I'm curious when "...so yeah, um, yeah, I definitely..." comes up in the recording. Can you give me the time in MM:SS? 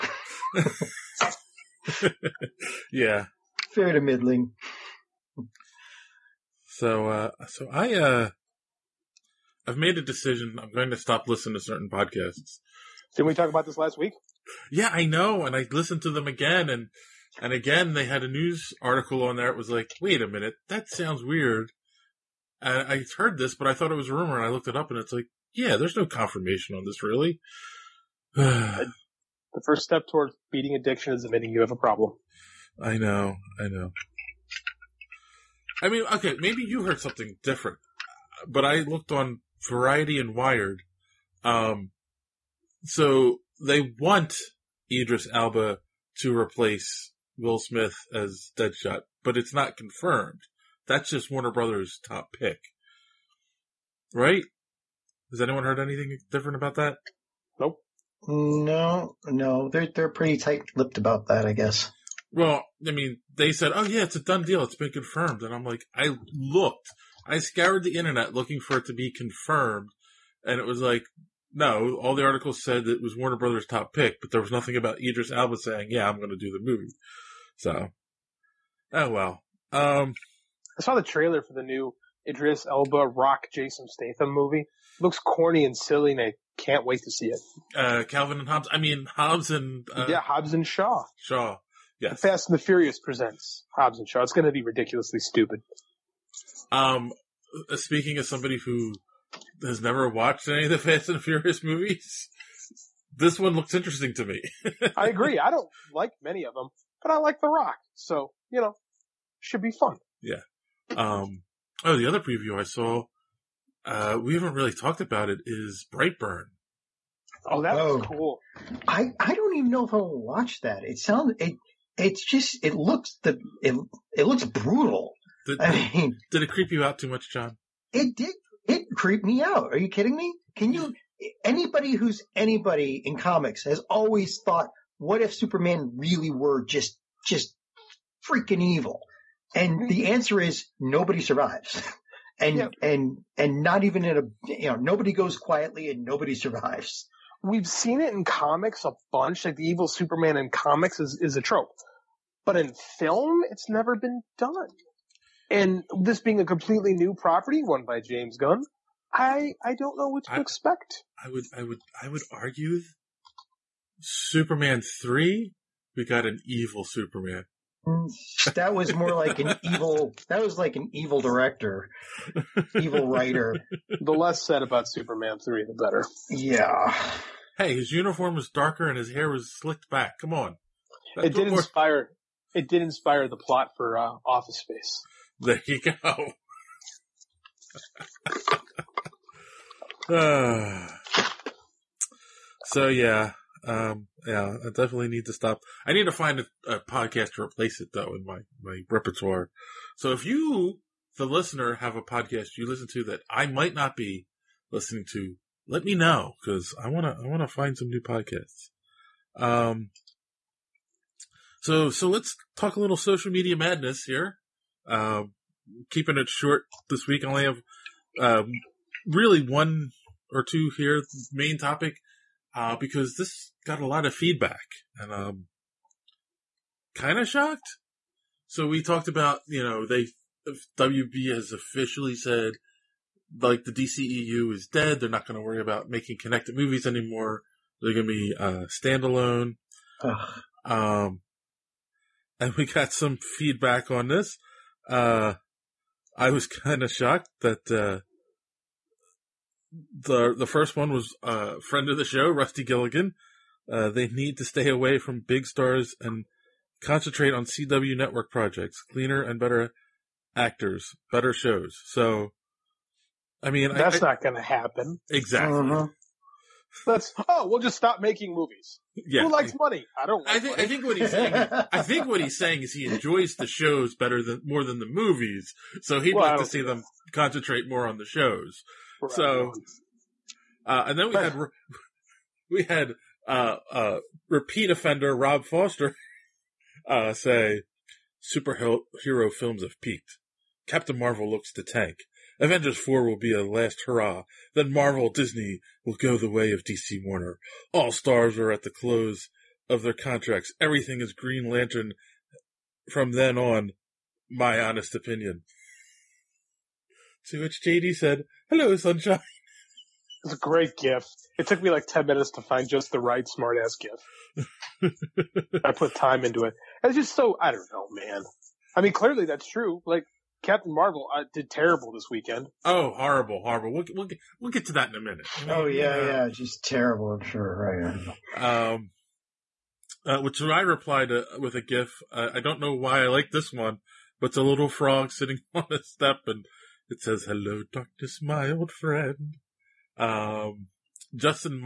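03:12.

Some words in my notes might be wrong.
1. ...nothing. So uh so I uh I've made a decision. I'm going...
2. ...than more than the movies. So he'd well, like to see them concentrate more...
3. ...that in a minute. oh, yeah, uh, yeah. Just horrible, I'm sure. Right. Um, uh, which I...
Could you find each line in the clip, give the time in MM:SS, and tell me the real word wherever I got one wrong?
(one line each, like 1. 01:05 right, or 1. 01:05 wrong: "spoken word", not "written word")
1. 00:04 wrong: "middling", not "nothing"
2. 04:34 right
3. 05:24 wrong: "terrible", not "horrible".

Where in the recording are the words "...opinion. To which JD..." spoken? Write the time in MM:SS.
05:04.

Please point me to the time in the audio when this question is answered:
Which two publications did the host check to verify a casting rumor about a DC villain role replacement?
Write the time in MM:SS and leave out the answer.
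00:39.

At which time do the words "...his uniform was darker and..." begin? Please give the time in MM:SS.
02:57.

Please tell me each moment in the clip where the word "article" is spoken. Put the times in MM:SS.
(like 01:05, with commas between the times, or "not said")
00:18, 01:12.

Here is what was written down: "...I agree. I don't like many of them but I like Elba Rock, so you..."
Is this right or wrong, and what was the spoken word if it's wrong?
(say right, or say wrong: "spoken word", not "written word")
wrong: "The", not "Elba".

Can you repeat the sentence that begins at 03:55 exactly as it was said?
They're not going to worry about making connected movies anymore.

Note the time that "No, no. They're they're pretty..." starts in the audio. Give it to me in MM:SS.
00:58.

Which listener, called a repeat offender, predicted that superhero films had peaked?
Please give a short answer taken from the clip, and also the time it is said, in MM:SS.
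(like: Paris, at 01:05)
Rob Foster, at 04:45.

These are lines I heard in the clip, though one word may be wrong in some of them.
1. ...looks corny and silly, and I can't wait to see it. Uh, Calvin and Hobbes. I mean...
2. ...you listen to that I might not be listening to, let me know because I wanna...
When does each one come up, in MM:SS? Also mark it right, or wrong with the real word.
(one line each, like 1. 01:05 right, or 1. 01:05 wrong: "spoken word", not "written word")
1. 01:25 right
2. 03:22 right.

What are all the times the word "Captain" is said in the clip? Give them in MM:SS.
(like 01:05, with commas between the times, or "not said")
04:50, 05:20.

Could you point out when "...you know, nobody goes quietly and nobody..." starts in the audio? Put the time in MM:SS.
02:24.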